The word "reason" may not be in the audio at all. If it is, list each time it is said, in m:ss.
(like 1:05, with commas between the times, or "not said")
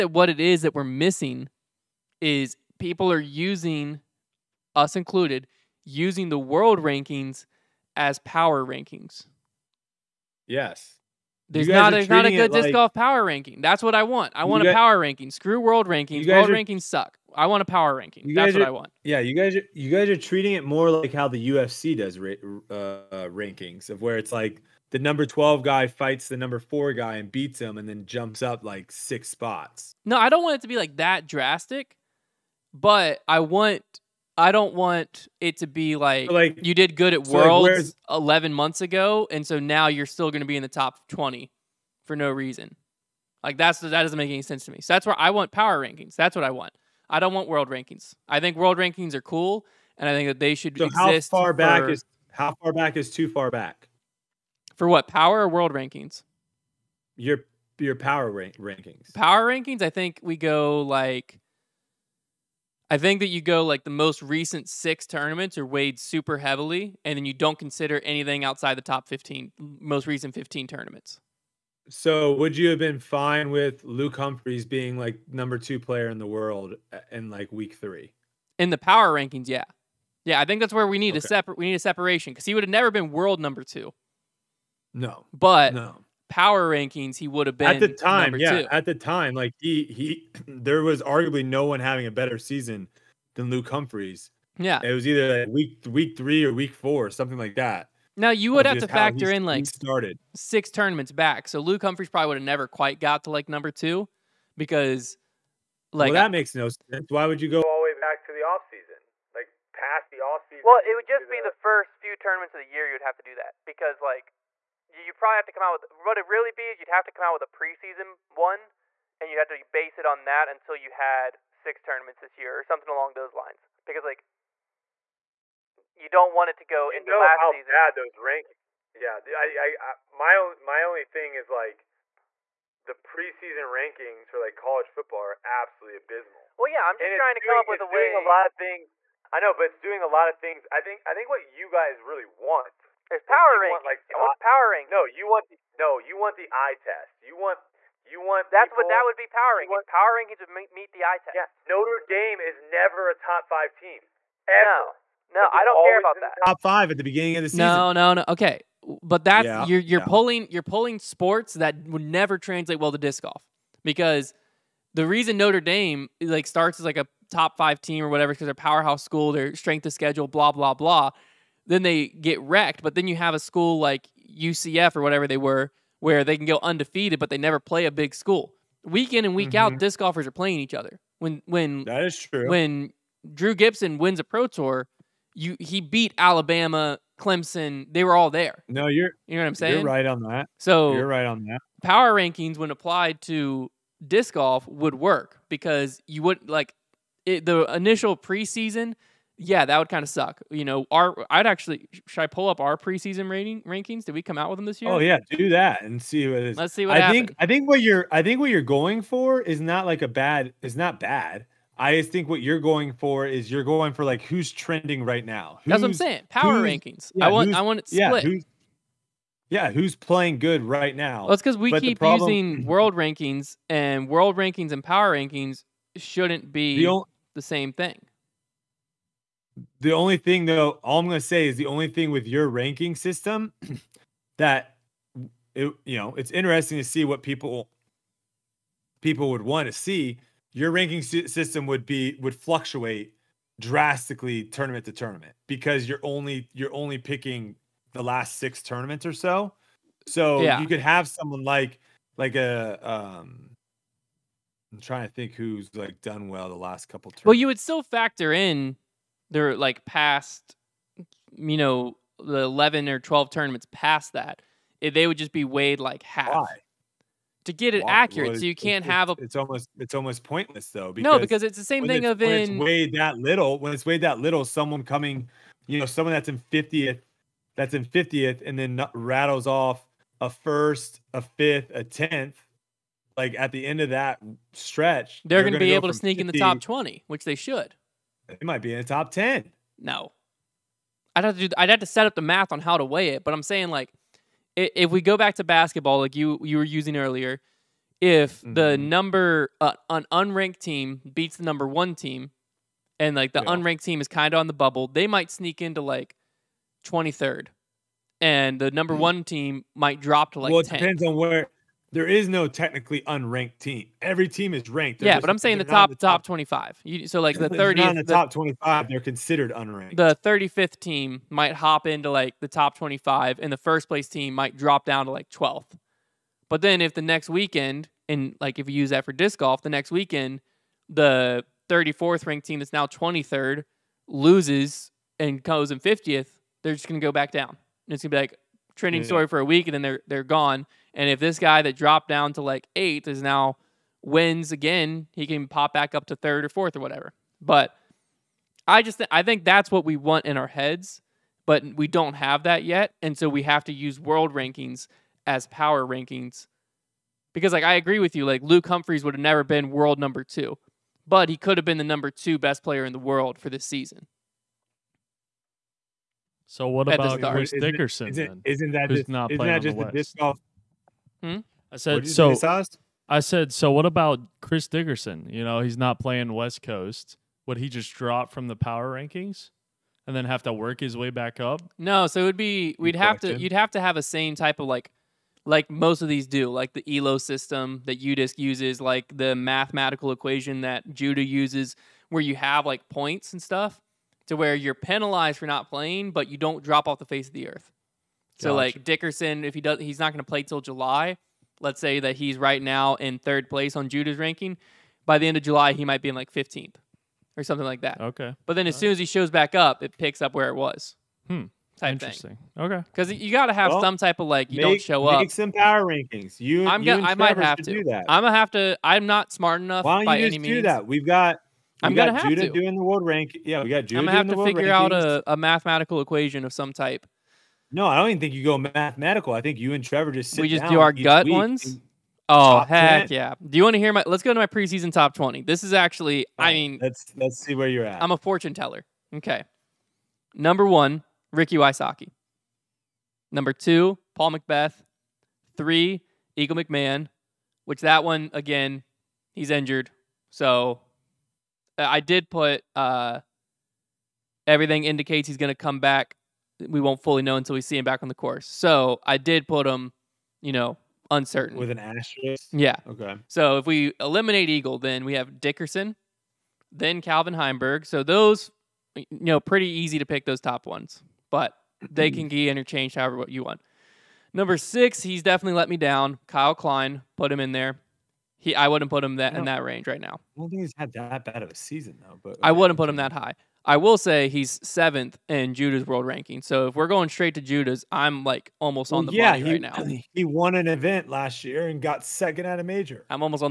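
0:42, 2:45.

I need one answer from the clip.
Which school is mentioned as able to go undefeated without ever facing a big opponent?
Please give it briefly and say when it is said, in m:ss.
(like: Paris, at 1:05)
UCF, at 2:54.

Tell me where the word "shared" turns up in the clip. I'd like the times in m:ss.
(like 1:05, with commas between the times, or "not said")
not said.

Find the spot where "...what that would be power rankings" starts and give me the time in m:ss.
2:28.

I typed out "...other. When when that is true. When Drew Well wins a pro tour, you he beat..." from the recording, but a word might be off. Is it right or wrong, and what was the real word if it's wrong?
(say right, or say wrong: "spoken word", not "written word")
wrong: "Gibson", not "Well".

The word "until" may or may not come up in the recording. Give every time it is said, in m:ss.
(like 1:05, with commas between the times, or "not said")
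2:00, 7:37.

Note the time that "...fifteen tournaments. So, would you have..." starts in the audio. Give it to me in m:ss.
1:10.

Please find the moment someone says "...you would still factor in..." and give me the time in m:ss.
4:17.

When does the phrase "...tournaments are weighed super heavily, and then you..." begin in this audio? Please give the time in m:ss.
1:05.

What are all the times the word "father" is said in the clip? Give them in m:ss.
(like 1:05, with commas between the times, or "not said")
not said.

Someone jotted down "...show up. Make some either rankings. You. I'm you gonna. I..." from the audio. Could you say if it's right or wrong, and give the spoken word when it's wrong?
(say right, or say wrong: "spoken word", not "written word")
wrong: "power", not "either".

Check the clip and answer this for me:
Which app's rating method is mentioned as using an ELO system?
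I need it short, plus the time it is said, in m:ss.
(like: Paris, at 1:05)
UDisc, at 6:28.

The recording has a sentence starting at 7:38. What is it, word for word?
So I did put him, you know, uncertain with an asterisk.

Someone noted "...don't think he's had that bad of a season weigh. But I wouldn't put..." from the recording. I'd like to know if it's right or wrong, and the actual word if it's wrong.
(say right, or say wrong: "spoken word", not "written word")
wrong: "though", not "weigh".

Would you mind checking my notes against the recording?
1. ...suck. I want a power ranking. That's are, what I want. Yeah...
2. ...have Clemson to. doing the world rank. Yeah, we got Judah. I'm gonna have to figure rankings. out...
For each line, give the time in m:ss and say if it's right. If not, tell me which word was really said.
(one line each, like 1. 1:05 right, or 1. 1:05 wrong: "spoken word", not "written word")
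1. 0:16 right
2. 7:02 wrong: "Judah", not "Clemson".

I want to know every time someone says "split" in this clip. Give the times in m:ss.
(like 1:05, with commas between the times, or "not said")
3:37.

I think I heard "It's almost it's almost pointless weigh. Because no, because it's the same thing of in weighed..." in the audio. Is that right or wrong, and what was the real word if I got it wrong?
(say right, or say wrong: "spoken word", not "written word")
wrong: "though", not "weigh".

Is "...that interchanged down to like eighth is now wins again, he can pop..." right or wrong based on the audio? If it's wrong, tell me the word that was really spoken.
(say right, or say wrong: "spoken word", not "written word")
wrong: "dropped", not "interchanged".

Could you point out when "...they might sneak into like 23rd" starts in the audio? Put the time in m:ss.
5:04.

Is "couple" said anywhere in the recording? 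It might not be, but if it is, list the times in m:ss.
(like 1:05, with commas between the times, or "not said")
4:16.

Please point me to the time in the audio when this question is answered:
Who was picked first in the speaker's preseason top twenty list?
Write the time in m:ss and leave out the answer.
7:21.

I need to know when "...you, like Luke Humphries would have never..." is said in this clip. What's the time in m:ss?
5:58.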